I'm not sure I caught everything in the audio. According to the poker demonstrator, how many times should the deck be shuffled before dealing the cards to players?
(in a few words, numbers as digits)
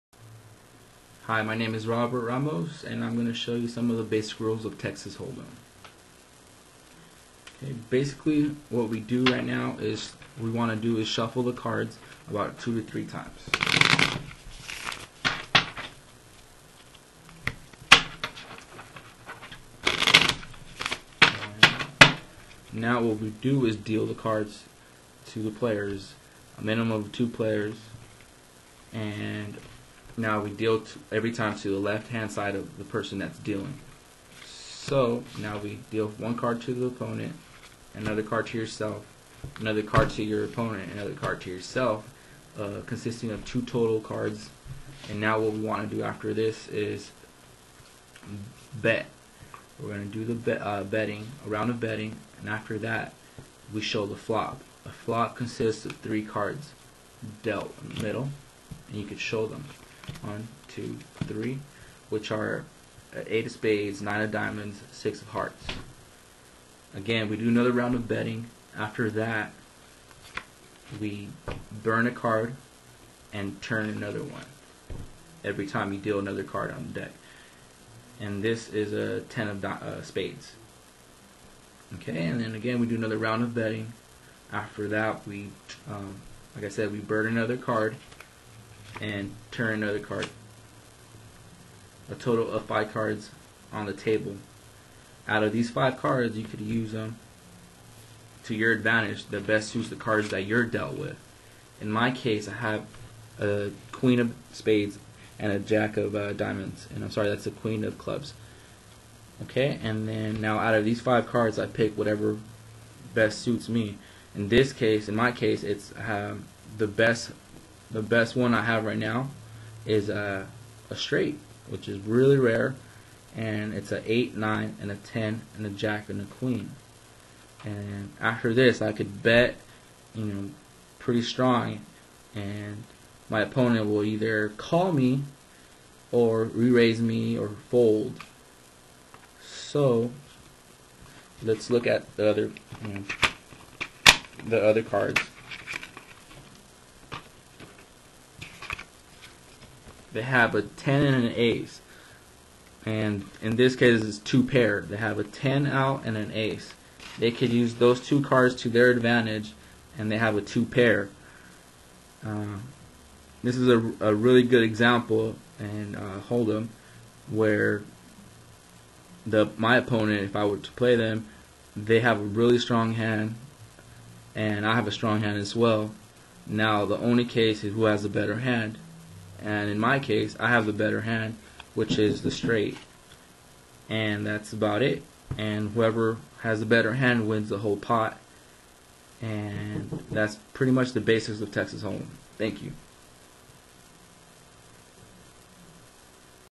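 2 to 3 times.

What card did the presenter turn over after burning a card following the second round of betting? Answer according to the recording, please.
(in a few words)
10 of spades.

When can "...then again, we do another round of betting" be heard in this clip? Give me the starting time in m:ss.
1:22.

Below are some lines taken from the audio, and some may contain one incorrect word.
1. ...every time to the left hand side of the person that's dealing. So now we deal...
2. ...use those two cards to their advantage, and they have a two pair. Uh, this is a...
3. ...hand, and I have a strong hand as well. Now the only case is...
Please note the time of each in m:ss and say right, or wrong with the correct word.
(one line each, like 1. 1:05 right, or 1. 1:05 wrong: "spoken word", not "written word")
1. 0:31 right
2. 2:37 right
3. 2:52 right.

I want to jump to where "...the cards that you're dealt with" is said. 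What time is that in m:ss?
1:39.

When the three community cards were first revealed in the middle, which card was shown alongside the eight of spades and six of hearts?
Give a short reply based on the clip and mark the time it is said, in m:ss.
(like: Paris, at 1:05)
Nine of diamonds, at 1:04.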